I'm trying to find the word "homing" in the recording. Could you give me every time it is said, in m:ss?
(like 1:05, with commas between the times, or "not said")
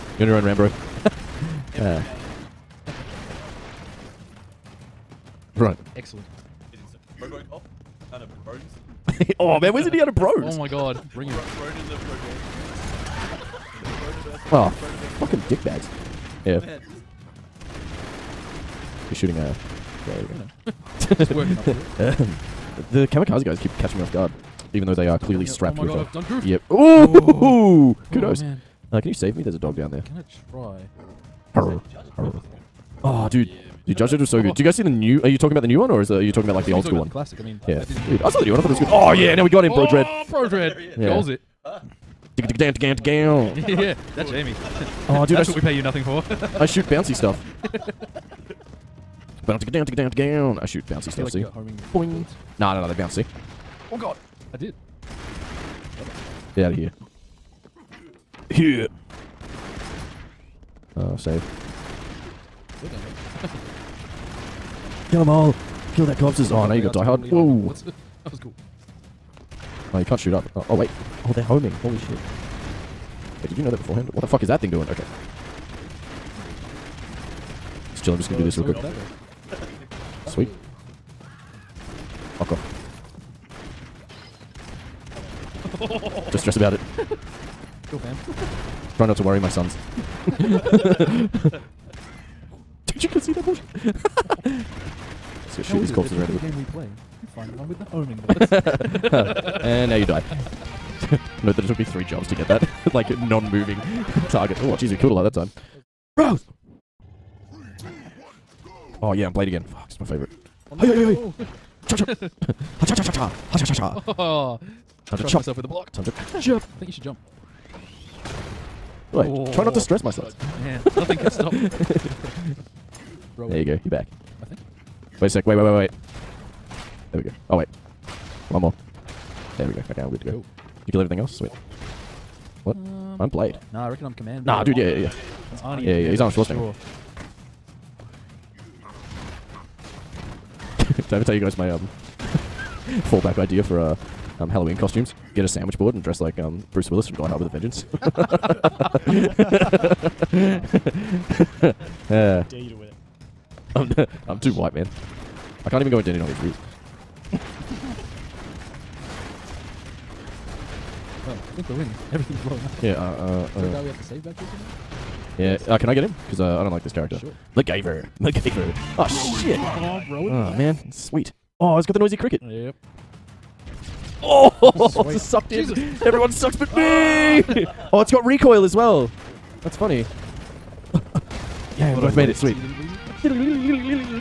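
1:11, 1:37.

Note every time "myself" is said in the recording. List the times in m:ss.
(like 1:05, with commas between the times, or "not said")
1:55, 2:00.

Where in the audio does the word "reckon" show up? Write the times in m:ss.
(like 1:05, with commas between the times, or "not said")
2:13.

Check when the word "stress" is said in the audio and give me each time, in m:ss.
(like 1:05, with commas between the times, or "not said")
1:26, 1:59.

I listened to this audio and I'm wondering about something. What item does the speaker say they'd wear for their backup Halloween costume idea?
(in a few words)
A sandwich board.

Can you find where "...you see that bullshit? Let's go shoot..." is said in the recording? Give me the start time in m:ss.
1:33.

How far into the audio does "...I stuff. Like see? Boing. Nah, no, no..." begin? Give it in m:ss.
0:51.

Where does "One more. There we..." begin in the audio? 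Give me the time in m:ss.
2:08.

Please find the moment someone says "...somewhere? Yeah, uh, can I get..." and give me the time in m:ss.
2:44.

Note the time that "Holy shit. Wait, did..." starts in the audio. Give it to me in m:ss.
1:11.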